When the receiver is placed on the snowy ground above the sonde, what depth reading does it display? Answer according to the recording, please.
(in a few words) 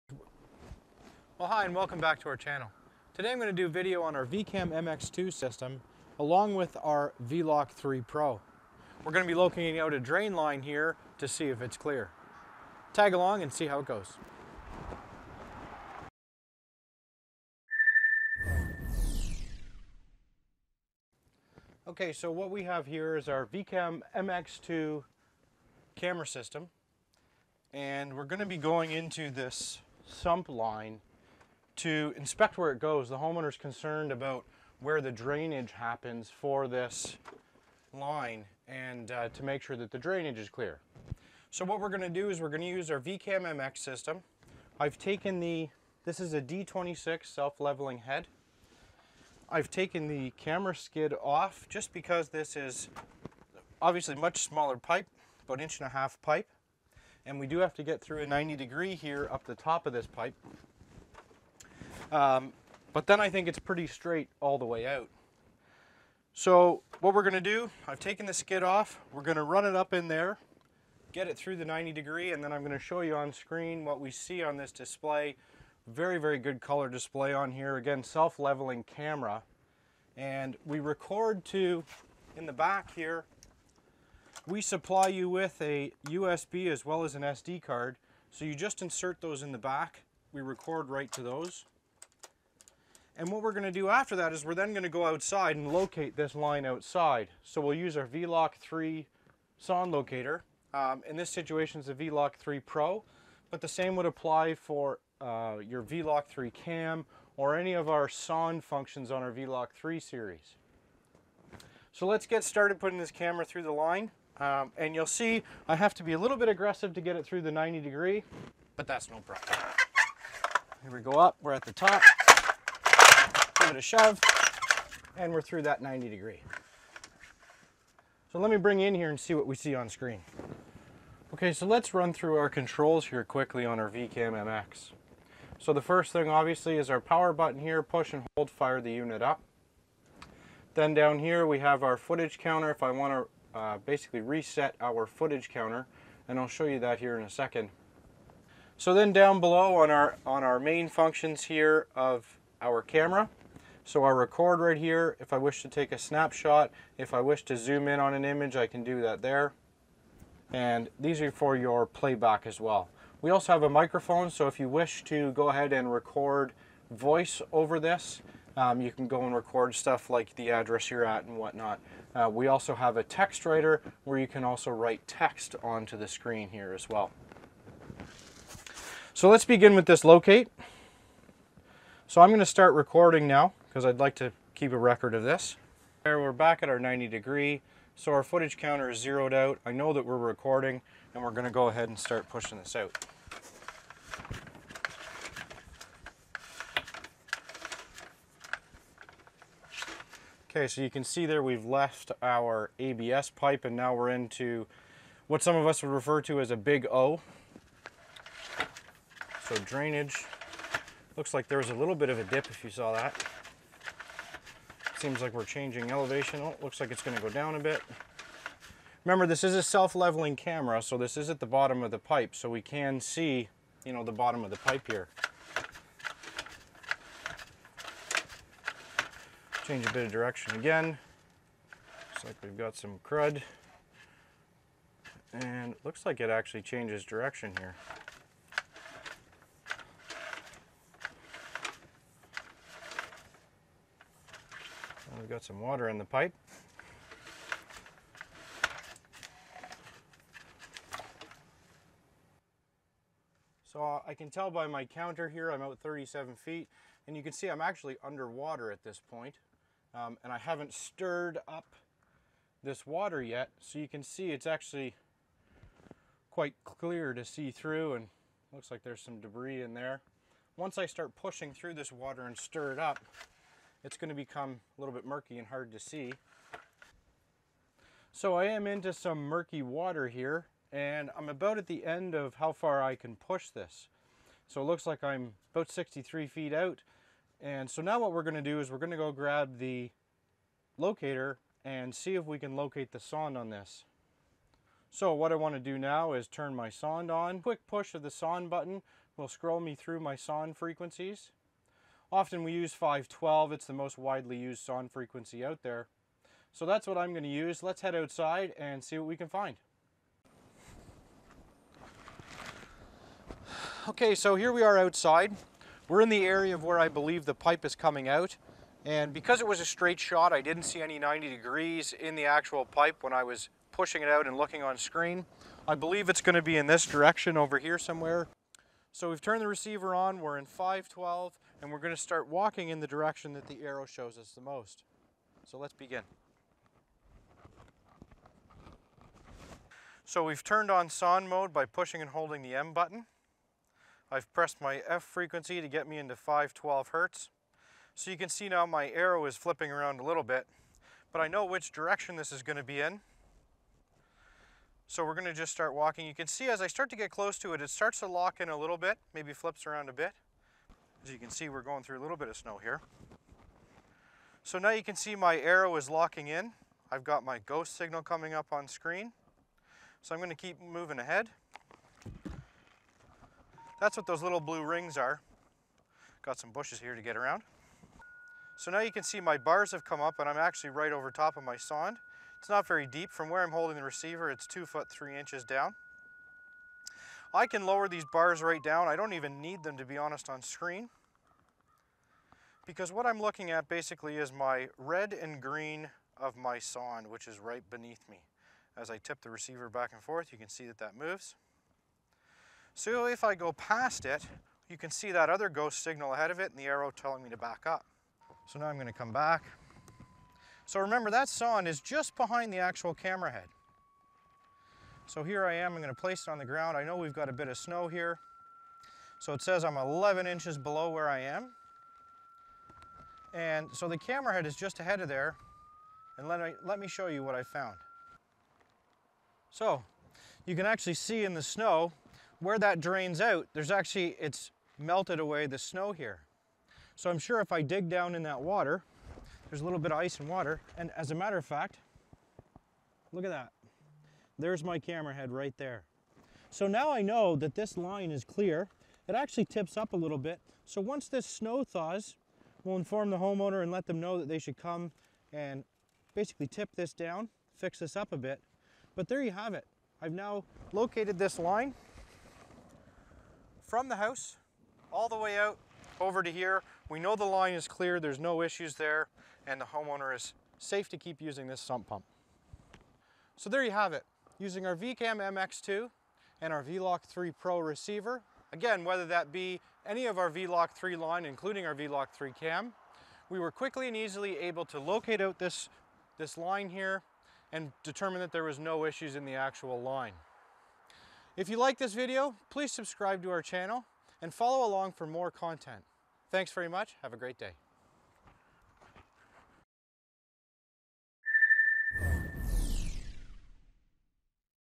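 11 inches.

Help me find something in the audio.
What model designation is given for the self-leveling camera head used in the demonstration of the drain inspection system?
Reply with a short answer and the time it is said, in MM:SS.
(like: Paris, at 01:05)
D26, at 00:46.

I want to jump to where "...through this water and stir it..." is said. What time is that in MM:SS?
04:31.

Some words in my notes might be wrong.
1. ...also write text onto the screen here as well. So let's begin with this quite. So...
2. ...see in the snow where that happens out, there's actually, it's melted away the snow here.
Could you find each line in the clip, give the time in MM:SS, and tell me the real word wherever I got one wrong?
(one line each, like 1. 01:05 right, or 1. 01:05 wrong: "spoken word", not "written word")
1. 02:54 wrong: "locate", not "quite"
2. 07:10 wrong: "drains", not "happens".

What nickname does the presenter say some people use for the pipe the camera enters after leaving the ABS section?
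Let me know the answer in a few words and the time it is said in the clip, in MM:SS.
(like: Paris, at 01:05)
big O, at 03:26.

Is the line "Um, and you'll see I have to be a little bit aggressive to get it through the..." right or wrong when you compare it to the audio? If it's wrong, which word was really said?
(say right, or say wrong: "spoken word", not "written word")
right.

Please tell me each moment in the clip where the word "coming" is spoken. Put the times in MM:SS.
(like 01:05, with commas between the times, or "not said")
05:17, 06:08.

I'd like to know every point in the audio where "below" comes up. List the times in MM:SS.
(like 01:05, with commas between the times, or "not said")
02:29, 07:00.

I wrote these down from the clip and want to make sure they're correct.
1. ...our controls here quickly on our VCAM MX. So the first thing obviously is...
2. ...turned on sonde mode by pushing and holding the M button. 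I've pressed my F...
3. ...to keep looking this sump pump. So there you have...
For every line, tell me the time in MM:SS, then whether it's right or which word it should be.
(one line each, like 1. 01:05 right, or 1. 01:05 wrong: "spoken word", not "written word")
1. 02:12 right
2. 05:40 right
3. 07:50 wrong: "using", not "looking".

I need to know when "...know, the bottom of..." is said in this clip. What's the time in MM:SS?
03:43.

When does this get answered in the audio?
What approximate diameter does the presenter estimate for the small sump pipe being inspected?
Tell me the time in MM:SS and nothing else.
00:55.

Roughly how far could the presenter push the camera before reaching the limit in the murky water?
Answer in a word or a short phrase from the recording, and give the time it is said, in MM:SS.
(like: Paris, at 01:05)
63 feet, at 04:45.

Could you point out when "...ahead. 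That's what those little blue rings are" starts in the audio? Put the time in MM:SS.
06:10.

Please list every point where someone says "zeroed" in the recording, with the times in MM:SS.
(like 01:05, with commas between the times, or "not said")
03:08.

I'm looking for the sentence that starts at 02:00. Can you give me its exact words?
Here we go up, we're at the top it a shove and we're through that 90 degree.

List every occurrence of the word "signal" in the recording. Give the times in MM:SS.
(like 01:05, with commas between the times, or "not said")
06:07, 06:45.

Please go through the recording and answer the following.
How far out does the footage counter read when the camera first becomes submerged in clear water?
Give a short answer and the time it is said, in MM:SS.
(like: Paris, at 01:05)
37 feet, at 04:15.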